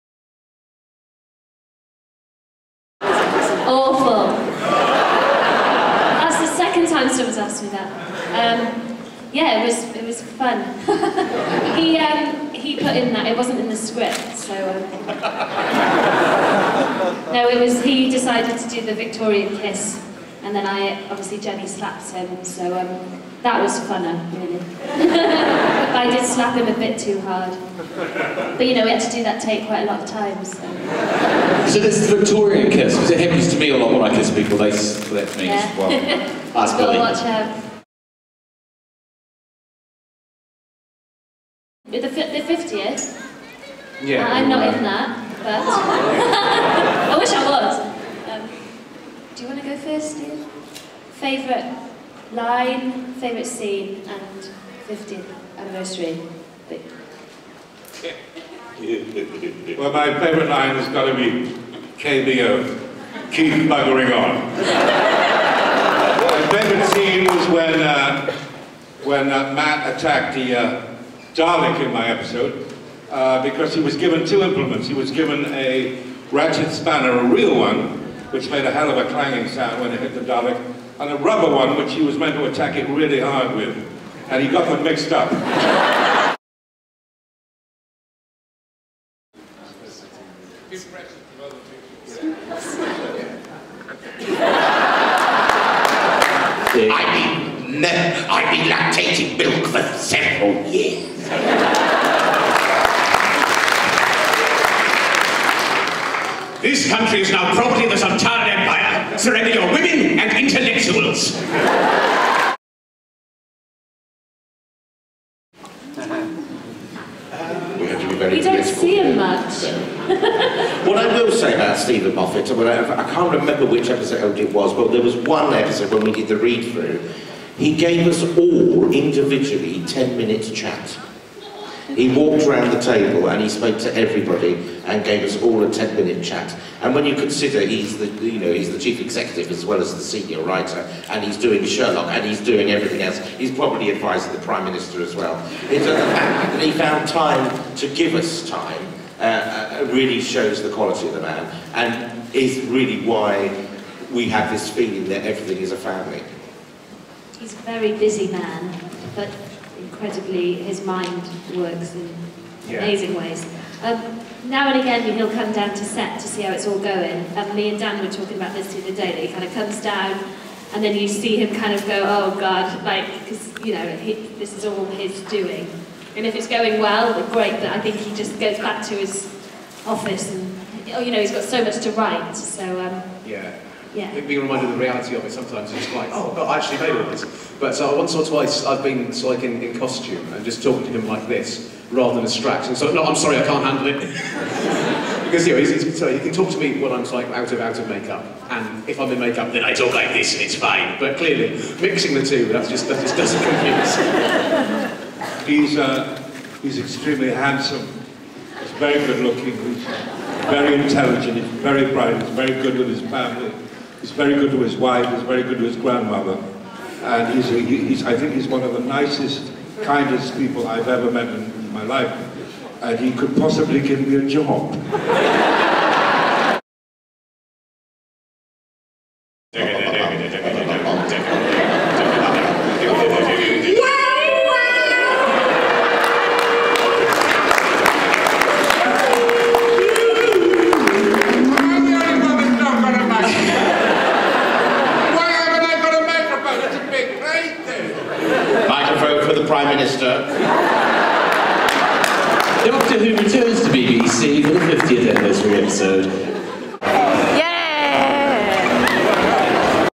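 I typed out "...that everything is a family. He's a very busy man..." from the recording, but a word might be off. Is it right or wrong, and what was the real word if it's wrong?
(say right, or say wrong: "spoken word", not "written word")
right.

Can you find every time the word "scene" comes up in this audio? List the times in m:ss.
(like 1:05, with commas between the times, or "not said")
0:53, 1:06.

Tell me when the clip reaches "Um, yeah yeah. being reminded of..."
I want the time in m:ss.
3:02.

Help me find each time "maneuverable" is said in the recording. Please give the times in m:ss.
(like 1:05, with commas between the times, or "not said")
not said.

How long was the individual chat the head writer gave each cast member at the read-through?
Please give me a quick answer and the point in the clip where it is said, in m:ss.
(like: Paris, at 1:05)
10 minutes, at 2:09.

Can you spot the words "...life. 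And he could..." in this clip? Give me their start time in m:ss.
3:41.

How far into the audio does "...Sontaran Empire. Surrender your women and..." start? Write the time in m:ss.
1:47.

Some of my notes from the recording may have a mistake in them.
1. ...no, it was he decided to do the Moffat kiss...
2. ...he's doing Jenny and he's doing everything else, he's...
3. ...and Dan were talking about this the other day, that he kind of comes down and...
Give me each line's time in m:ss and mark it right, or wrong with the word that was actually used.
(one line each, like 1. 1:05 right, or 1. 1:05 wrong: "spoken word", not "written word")
1. 0:17 wrong: "Victorian", not "Moffat"
2. 2:21 wrong: "Sherlock", not "Jenny"
3. 2:47 right.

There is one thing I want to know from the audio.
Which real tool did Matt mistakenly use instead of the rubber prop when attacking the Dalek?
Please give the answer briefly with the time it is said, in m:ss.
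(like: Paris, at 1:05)
Ratchet spanner, at 1:16.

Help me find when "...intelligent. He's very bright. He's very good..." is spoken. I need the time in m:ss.
3:30.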